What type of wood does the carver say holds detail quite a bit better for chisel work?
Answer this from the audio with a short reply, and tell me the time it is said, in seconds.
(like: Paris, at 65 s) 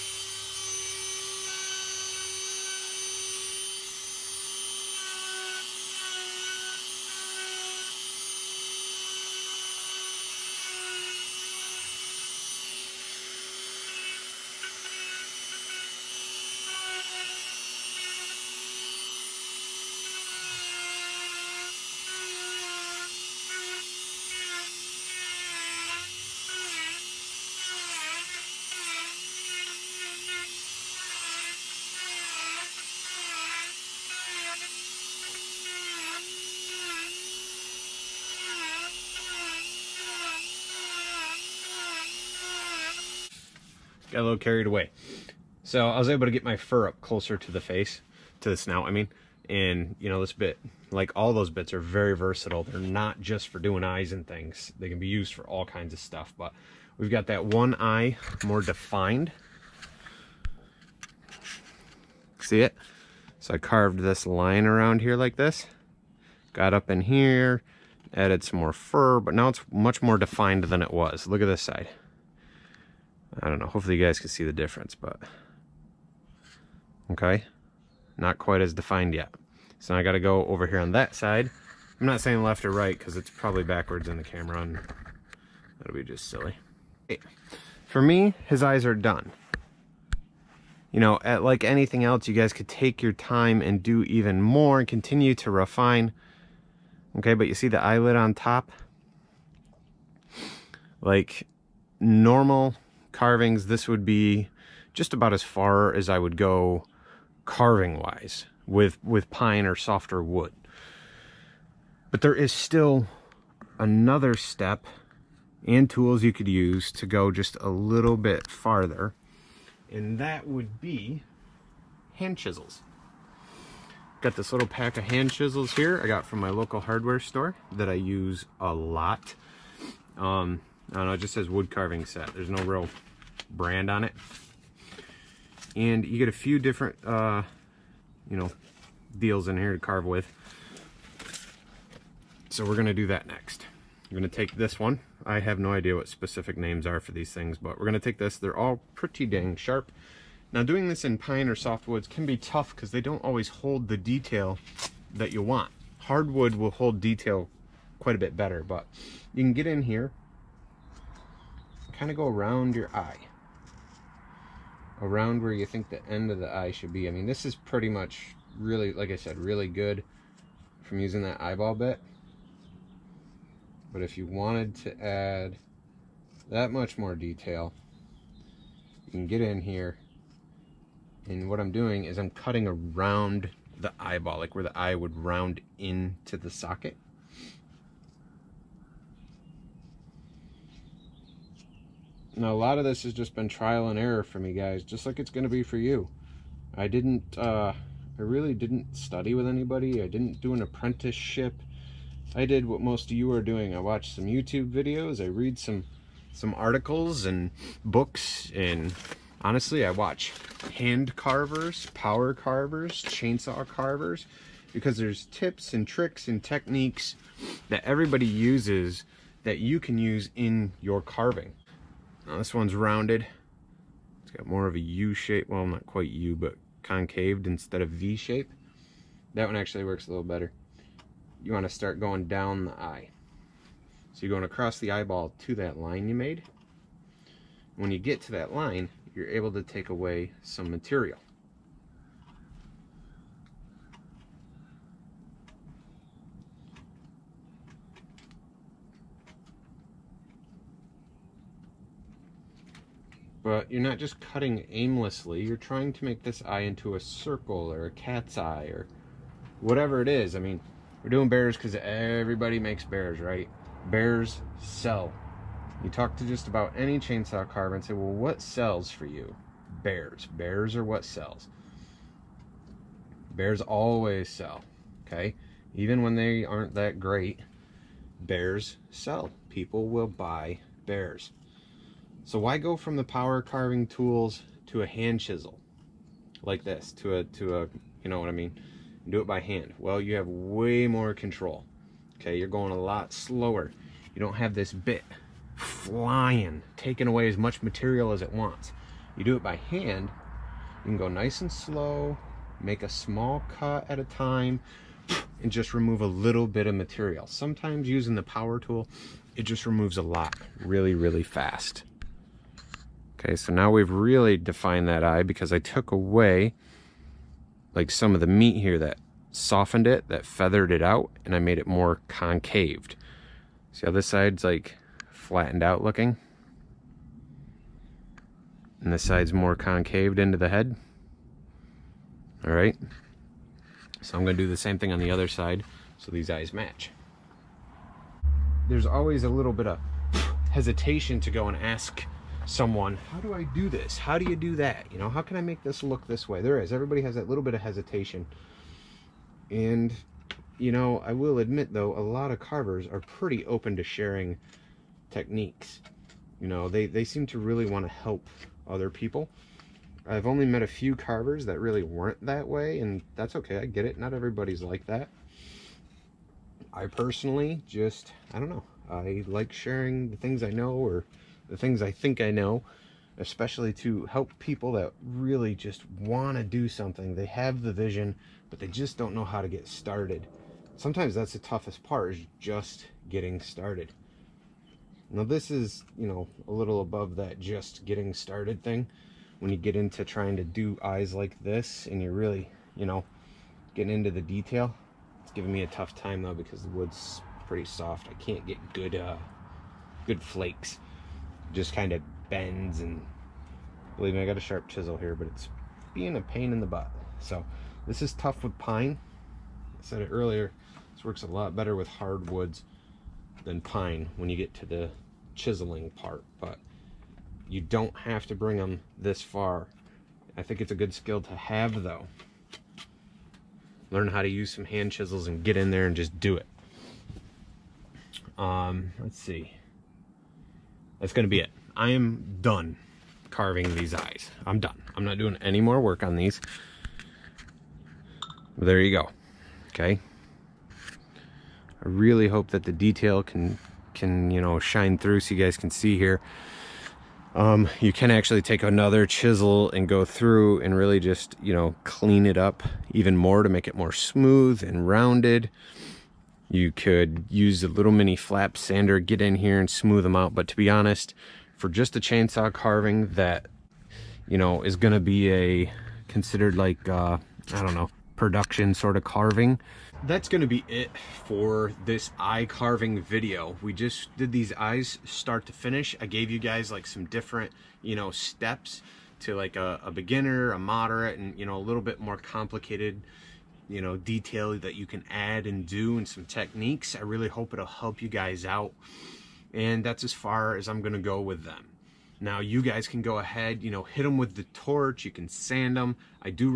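Hardwood, at 155 s.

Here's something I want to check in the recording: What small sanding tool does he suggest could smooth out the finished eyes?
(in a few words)
mini flap sander.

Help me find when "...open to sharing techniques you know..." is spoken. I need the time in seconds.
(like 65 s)
353 s.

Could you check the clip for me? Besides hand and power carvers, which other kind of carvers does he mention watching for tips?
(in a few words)
chainsaw carvers.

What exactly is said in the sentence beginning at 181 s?
And what I'm doing is I'm cutting around the eyeball, like where the eye would round into the socket.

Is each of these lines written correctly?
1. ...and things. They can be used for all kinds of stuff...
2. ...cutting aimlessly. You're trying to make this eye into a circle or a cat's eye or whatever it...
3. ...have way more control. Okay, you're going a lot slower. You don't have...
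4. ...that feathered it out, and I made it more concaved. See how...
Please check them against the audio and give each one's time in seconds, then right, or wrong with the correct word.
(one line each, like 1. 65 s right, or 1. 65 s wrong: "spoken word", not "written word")
1. 54 s right
2. 254 s right
3. 290 s right
4. 320 s right.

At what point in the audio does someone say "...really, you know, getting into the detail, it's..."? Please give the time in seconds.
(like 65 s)
392 s.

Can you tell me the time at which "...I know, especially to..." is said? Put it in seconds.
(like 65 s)
372 s.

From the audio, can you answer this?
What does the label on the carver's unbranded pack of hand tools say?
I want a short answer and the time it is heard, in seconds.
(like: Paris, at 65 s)
wood carving set, at 131 s.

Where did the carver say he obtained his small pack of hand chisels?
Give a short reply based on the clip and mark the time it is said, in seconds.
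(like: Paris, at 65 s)
local hardware store, at 126 s.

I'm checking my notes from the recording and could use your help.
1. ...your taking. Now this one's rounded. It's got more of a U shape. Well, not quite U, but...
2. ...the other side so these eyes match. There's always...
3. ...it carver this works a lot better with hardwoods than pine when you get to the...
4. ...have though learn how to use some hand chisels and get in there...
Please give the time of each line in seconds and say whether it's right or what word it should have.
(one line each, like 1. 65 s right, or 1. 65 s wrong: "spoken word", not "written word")
1. 220 s wrong: "carving", not "taking"
2. 334 s right
3. 410 s wrong: "earlier", not "carver"
4. 421 s right.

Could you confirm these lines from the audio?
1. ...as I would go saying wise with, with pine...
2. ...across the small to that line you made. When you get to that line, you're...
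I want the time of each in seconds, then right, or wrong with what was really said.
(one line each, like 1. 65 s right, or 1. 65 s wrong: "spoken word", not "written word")
1. 105 s wrong: "carving", not "saying"
2. 234 s wrong: "eyeball", not "small".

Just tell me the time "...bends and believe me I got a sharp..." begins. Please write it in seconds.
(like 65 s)
402 s.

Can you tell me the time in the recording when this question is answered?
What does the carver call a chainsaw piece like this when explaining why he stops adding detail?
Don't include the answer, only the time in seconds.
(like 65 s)
468 s.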